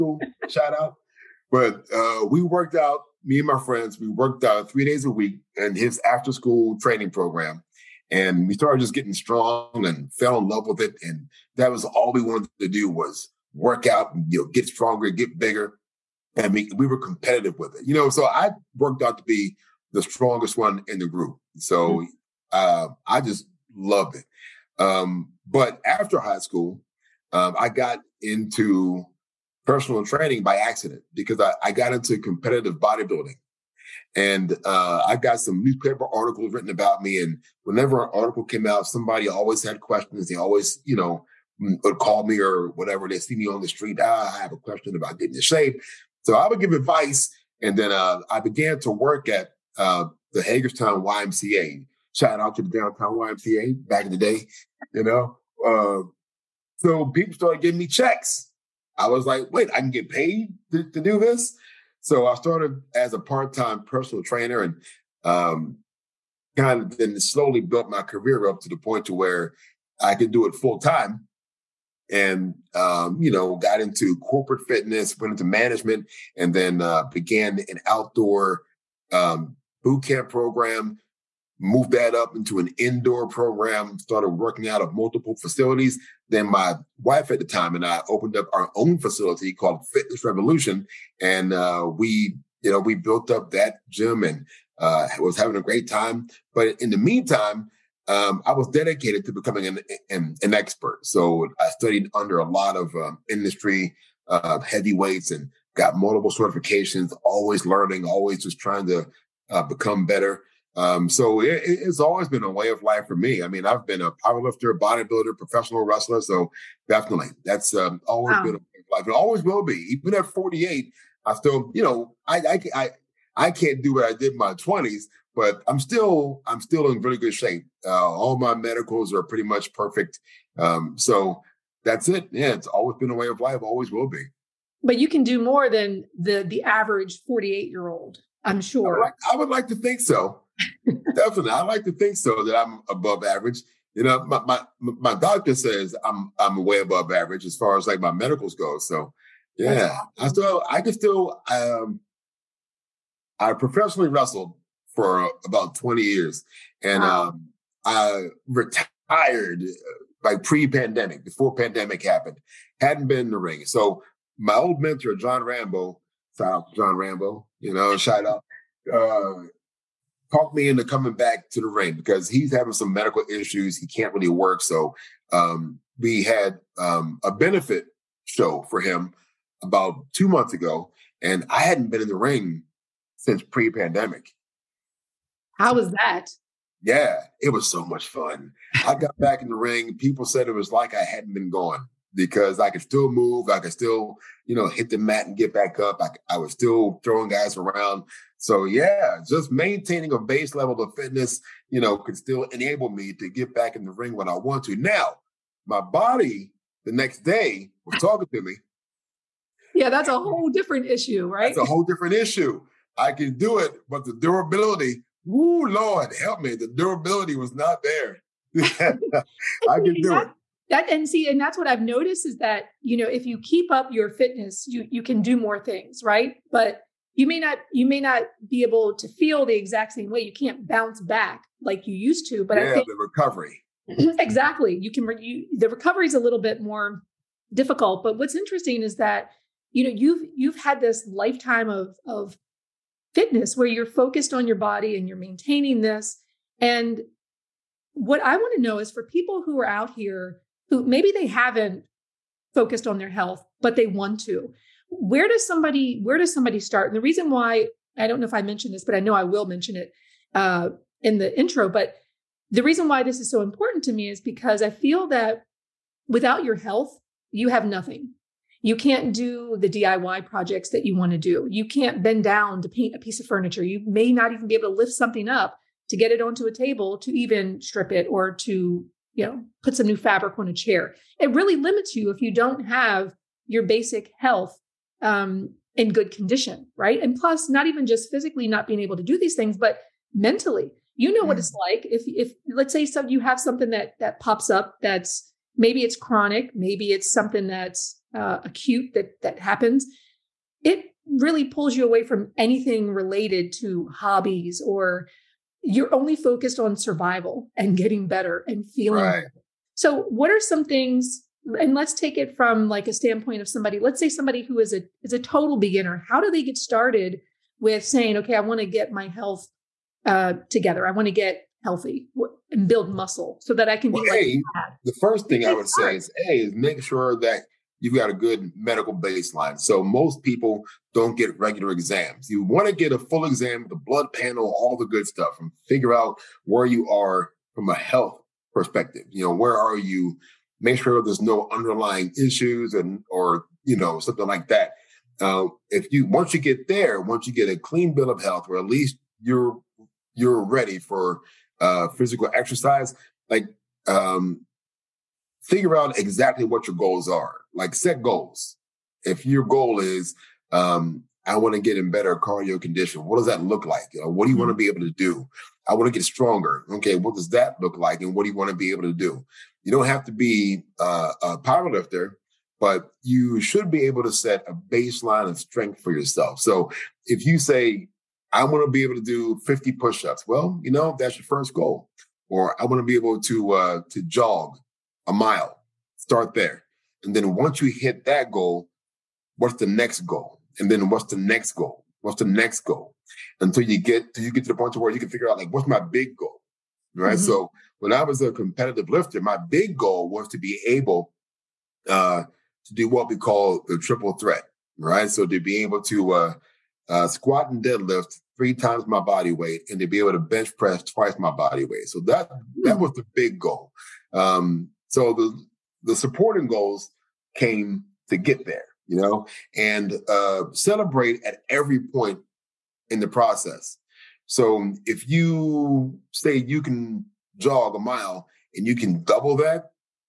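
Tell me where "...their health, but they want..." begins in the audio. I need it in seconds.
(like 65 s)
252 s.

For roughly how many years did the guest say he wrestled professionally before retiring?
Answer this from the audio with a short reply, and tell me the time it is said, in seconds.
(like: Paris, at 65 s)
20, at 155 s.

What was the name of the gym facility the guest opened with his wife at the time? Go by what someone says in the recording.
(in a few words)
Fitness Revolution.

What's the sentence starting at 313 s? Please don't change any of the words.
Let's say somebody who is a is a total beginner.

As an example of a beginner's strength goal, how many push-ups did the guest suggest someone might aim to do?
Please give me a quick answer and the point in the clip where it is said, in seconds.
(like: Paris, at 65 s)
50, at 379 s.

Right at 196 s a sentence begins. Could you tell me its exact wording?
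I, I was still throwing guys around.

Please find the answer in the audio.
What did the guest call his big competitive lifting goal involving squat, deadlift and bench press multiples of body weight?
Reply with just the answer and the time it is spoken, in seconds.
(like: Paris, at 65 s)
the triple threat, at 403 s.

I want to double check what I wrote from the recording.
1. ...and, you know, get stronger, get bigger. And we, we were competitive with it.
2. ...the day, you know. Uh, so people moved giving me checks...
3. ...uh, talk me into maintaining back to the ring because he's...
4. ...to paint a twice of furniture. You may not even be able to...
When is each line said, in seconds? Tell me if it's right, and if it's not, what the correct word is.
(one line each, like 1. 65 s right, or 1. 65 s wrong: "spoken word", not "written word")
1. 14 s right
2. 54 s wrong: "started", not "moved"
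3. 168 s wrong: "coming", not "maintaining"
4. 272 s wrong: "piece", not "twice".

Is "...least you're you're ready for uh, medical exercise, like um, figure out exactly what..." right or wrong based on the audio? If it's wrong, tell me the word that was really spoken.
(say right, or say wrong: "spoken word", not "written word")
wrong: "physical", not "medical".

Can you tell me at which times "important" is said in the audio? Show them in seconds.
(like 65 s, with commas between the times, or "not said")
263 s.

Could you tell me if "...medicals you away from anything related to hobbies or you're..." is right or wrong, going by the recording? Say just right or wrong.
wrong.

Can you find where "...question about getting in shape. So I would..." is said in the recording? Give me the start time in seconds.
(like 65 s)
44 s.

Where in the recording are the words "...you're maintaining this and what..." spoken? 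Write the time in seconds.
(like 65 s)
245 s.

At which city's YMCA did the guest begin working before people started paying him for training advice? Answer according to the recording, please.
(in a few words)
Hagerstown.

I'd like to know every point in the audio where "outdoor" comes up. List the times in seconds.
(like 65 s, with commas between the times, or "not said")
77 s.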